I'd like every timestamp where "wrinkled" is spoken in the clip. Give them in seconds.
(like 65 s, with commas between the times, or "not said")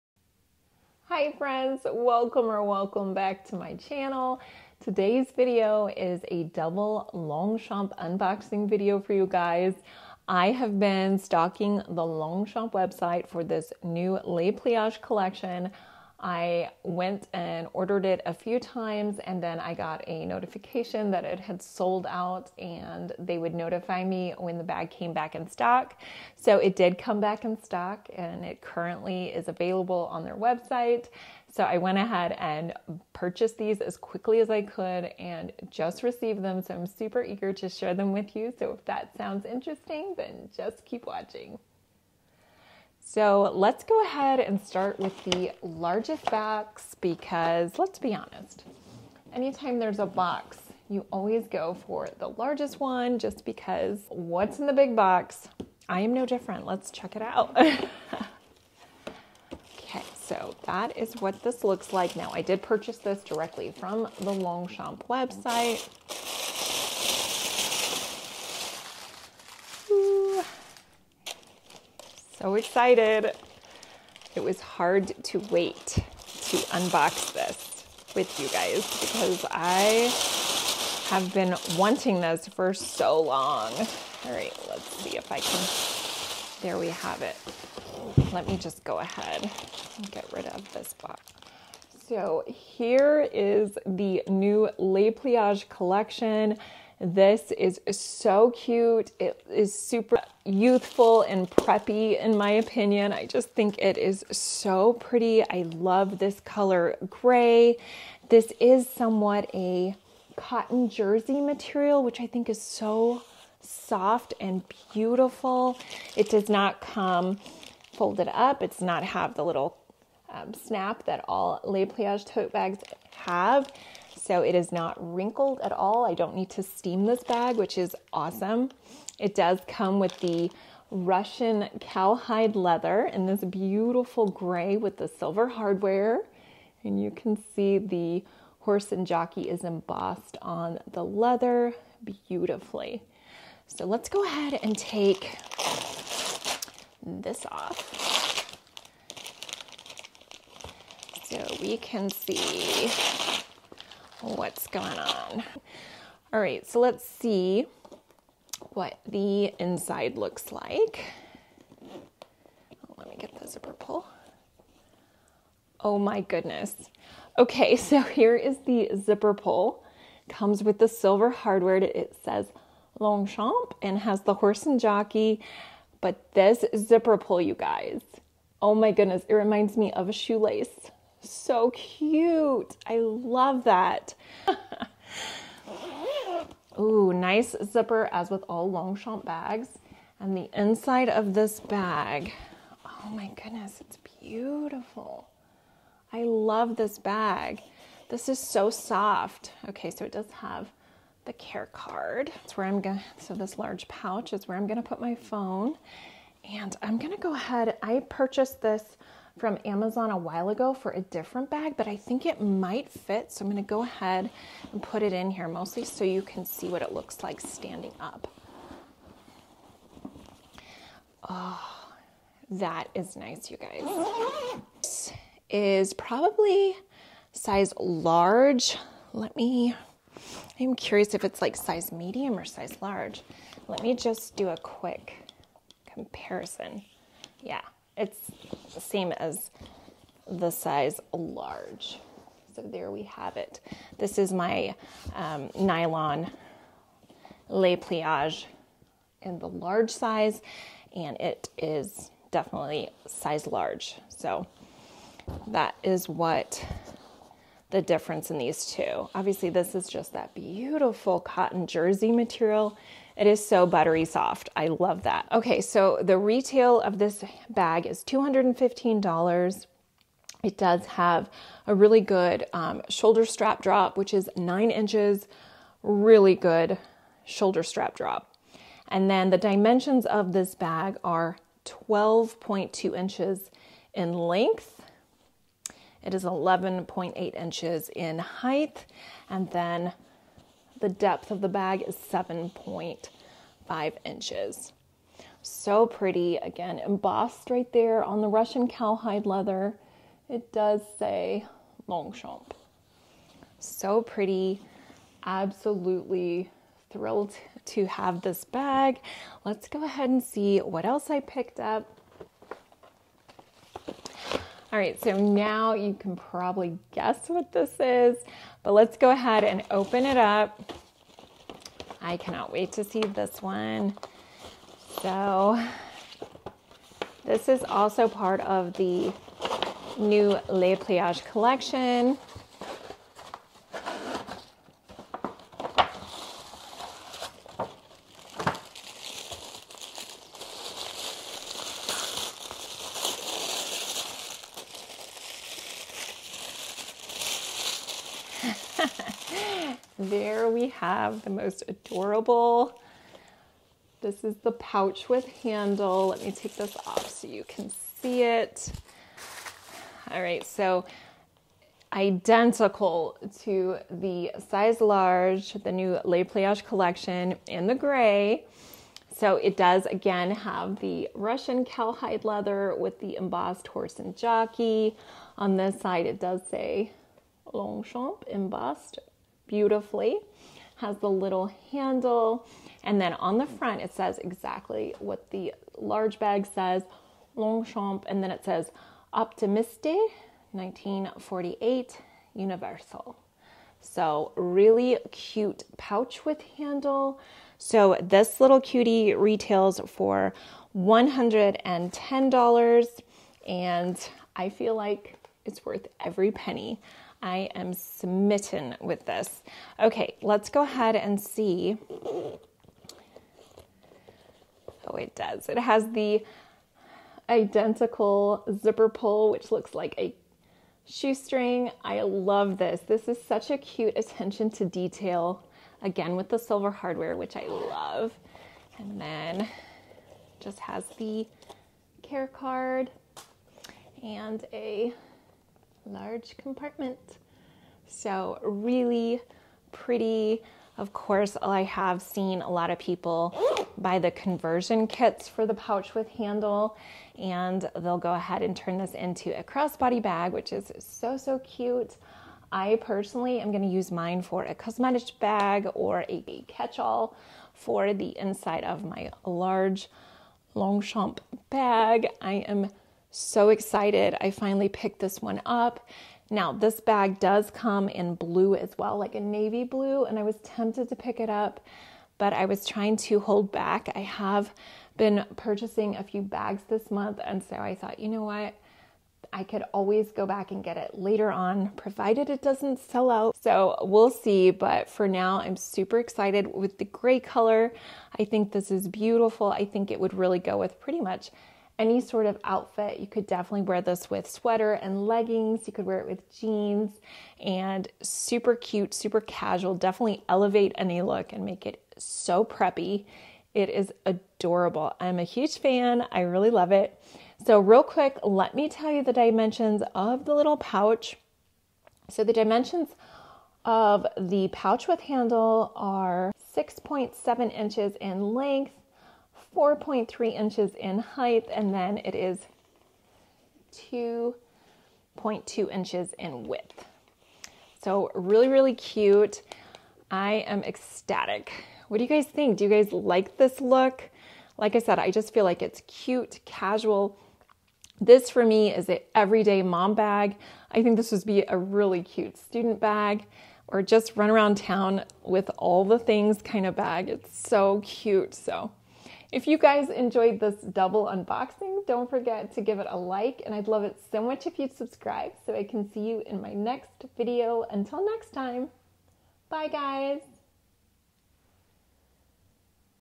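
124 s.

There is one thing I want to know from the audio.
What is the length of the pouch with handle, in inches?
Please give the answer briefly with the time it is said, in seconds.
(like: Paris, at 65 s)
6.7 inches, at 516 s.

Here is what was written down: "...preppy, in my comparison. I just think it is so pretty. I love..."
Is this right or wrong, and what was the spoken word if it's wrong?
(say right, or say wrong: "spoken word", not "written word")
wrong: "opinion", not "comparison".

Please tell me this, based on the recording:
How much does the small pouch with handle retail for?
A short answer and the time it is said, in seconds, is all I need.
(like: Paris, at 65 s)
$110, at 400 s.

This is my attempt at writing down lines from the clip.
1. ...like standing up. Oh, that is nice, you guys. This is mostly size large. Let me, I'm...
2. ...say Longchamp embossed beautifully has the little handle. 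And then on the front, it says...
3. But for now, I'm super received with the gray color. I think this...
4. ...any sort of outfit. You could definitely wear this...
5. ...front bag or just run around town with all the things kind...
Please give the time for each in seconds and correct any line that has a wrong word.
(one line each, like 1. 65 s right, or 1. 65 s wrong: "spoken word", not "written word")
1. 217 s wrong: "probably", not "mostly"
2. 376 s right
3. 484 s wrong: "excited", not "received"
4. 491 s right
5. 542 s wrong: "student", not "front".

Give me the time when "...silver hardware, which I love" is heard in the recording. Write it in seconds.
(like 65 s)
426 s.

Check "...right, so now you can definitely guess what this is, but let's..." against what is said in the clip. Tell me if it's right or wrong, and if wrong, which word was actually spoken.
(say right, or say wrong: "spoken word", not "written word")
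wrong: "probably", not "definitely".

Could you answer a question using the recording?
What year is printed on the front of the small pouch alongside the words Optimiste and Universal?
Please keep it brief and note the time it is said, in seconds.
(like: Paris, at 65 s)
1948, at 390 s.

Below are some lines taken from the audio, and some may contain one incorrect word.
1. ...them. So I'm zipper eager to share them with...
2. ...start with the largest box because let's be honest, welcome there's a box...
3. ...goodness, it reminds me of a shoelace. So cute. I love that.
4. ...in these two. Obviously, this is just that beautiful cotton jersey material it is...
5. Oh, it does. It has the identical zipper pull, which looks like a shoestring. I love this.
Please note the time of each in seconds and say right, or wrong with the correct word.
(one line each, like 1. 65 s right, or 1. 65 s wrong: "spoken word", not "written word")
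1. 36 s wrong: "super", not "zipper"
2. 44 s wrong: "anytime", not "welcome"
3. 178 s right
4. 258 s right
5. 411 s right.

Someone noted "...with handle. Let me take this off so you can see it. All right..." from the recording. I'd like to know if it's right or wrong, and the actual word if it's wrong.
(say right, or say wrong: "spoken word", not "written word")
right.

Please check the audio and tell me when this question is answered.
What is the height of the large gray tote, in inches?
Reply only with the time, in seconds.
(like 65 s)
286 s.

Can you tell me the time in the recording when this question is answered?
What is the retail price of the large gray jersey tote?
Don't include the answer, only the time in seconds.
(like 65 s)
268 s.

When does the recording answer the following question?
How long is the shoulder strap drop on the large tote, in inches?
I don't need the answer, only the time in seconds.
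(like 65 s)
274 s.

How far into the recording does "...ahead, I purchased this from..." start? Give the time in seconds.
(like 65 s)
207 s.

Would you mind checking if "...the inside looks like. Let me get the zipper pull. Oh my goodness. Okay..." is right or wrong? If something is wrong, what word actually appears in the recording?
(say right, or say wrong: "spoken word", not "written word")
right.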